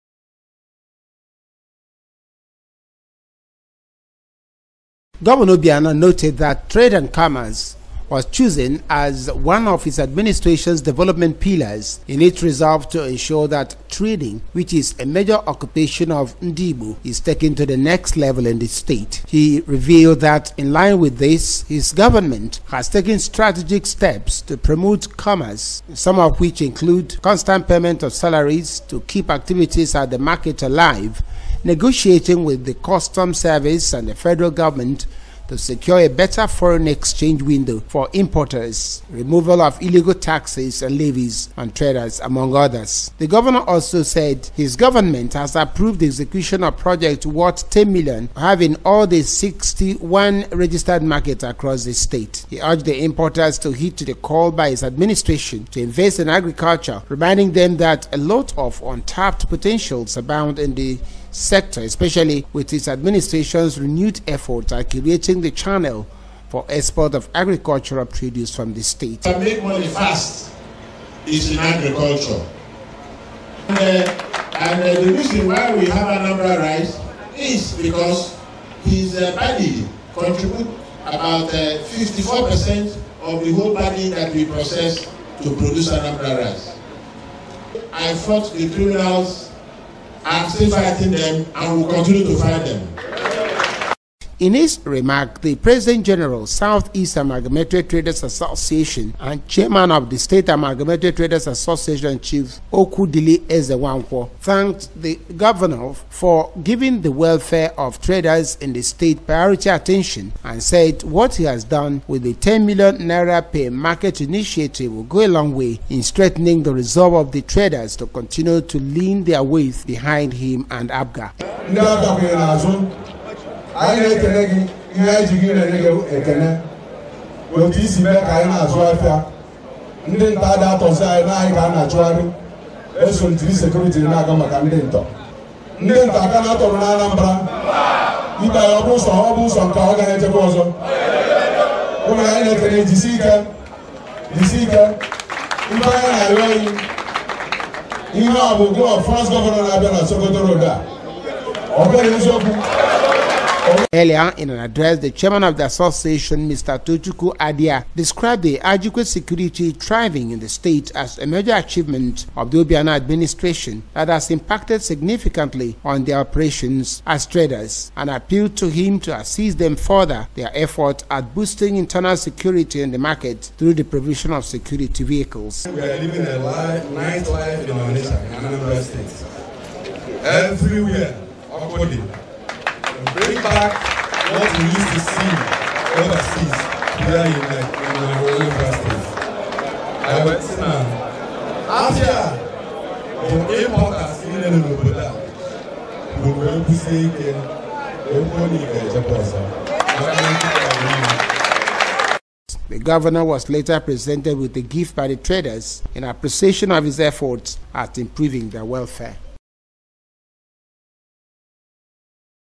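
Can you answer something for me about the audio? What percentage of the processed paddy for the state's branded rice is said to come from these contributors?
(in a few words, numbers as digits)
54%.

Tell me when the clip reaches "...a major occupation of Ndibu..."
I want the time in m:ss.
0:14.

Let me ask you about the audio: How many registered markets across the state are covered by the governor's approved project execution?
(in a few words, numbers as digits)
61.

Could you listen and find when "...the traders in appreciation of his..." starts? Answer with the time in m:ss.
3:25.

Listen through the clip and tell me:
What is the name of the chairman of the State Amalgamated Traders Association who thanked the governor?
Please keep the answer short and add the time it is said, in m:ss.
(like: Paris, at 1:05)
Okwudili Ezenwankwo, at 1:42.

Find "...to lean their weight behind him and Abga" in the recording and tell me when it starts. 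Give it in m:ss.
1:58.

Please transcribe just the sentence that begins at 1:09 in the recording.
To make money fast is in agriculture.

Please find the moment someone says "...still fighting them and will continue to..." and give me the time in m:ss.
1:30.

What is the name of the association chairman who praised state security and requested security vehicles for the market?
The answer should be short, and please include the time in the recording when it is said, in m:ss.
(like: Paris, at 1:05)
Tochukwu Adia, at 2:36.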